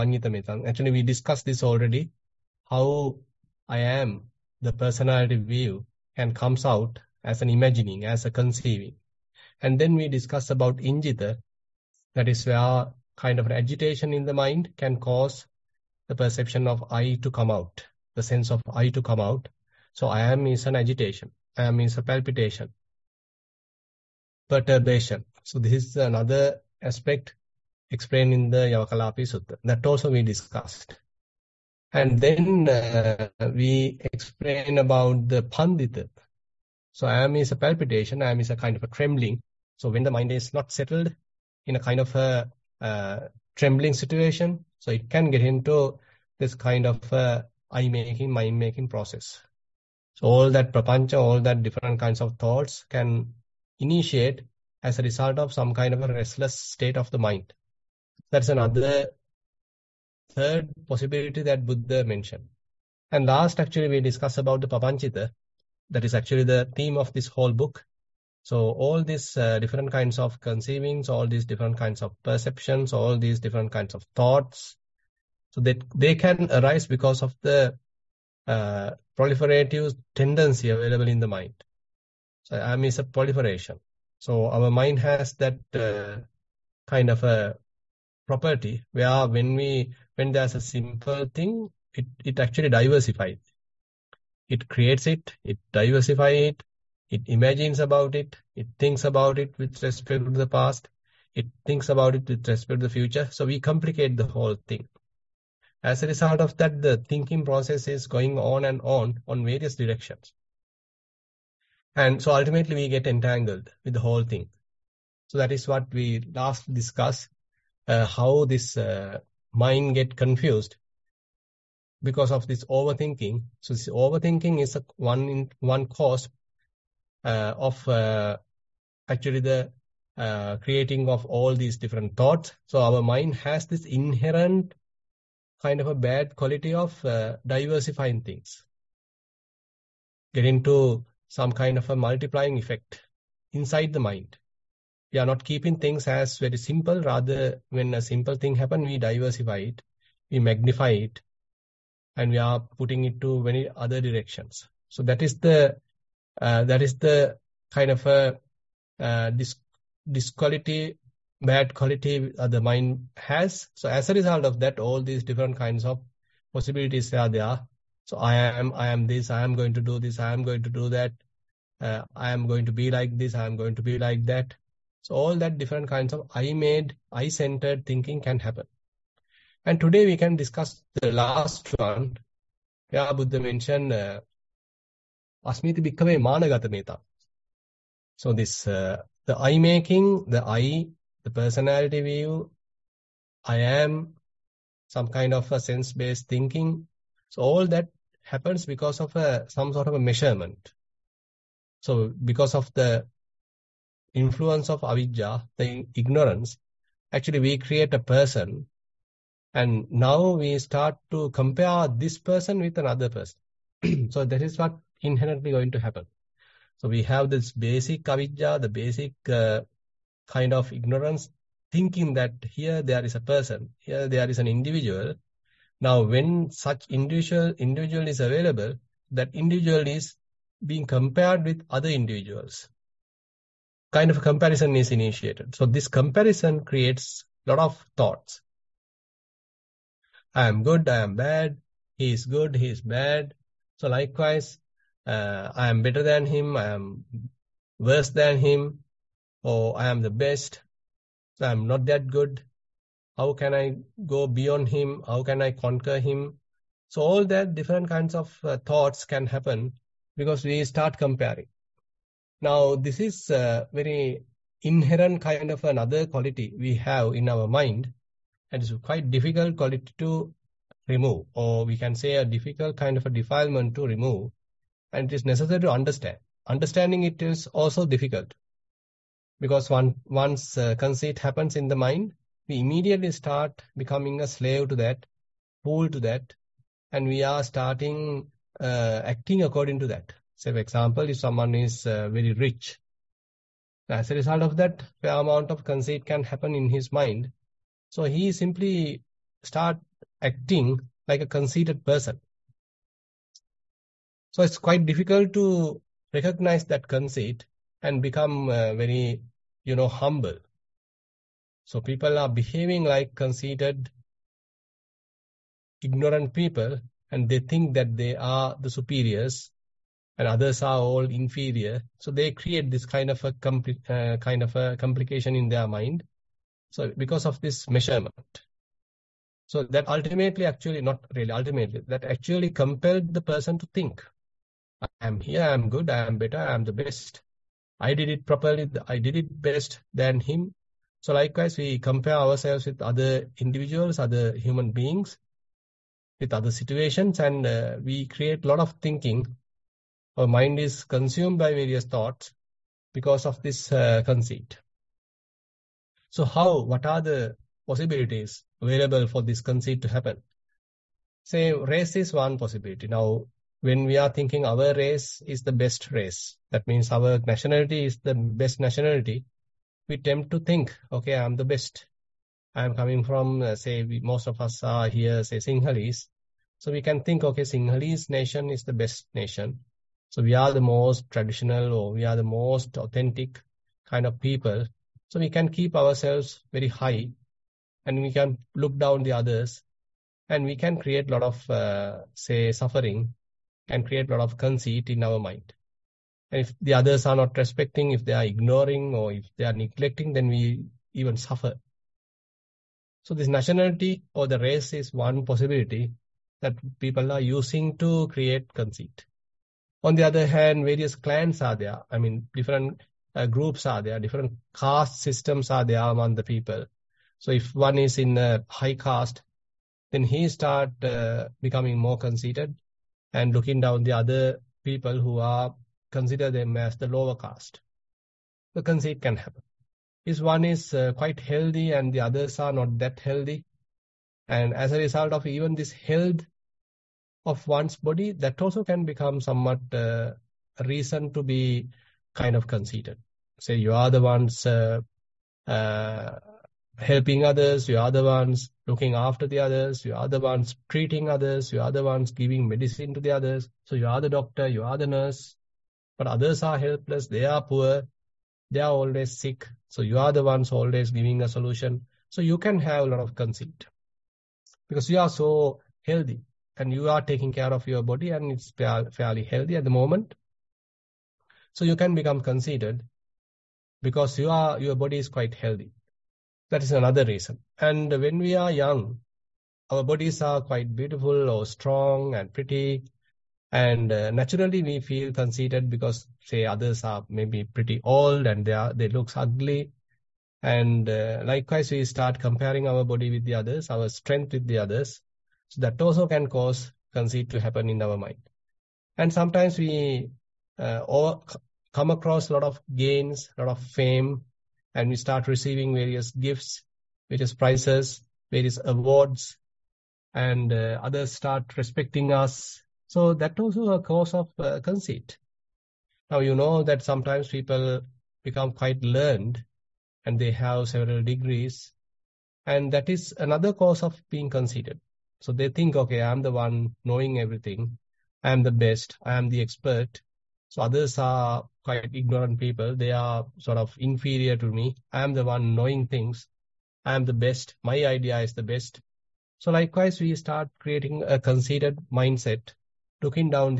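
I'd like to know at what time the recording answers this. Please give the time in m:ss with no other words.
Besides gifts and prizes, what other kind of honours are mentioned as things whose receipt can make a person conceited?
8:28.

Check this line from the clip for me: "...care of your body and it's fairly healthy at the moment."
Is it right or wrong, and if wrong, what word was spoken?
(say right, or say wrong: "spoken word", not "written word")
right.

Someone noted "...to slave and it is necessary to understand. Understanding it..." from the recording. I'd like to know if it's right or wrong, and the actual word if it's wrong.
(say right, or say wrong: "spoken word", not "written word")
wrong: "remove", not "slave".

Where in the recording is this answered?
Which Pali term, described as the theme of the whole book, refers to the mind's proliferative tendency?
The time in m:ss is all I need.
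1:04.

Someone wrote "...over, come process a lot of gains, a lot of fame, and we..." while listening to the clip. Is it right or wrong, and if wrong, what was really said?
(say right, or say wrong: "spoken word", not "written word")
wrong: "across", not "process".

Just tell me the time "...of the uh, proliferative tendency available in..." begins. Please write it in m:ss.
1:17.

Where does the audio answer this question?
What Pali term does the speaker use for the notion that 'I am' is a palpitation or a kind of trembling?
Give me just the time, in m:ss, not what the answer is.
0:35.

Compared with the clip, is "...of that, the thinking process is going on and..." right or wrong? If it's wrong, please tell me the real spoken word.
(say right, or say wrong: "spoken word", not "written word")
right.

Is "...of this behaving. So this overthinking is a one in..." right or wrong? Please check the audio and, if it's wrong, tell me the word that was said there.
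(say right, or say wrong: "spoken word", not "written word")
wrong: "overthinking", not "behaving".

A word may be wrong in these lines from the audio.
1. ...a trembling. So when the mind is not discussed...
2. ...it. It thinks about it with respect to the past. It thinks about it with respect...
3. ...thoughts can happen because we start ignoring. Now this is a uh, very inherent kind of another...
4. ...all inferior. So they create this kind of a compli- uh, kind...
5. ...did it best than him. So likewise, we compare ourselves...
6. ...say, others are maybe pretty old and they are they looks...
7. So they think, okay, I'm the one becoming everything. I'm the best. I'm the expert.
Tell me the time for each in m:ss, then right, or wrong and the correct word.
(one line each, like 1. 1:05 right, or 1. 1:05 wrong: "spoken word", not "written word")
1. 0:38 wrong: "settled", not "discussed"
2. 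1:38 right
3. 4:18 wrong: "comparing", not "ignoring"
4. 5:20 right
5. 5:38 right
6. 8:06 right
7. 8:45 wrong: "knowing", not "becoming".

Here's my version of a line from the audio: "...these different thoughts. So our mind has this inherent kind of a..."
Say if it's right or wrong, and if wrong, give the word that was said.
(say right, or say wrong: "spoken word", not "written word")
right.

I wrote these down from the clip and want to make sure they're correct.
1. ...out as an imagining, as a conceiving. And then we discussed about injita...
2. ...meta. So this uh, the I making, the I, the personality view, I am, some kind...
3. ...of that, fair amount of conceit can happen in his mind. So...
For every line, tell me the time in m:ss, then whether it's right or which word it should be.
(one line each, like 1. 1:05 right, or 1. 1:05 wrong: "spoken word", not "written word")
1. 0:06 right
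2. 3:06 right
3. 4:54 right.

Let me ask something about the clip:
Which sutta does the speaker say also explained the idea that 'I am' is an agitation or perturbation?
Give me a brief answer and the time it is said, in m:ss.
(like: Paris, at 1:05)
Yavakalapi Sutta, at 0:28.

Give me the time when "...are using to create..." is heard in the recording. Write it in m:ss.
6:47.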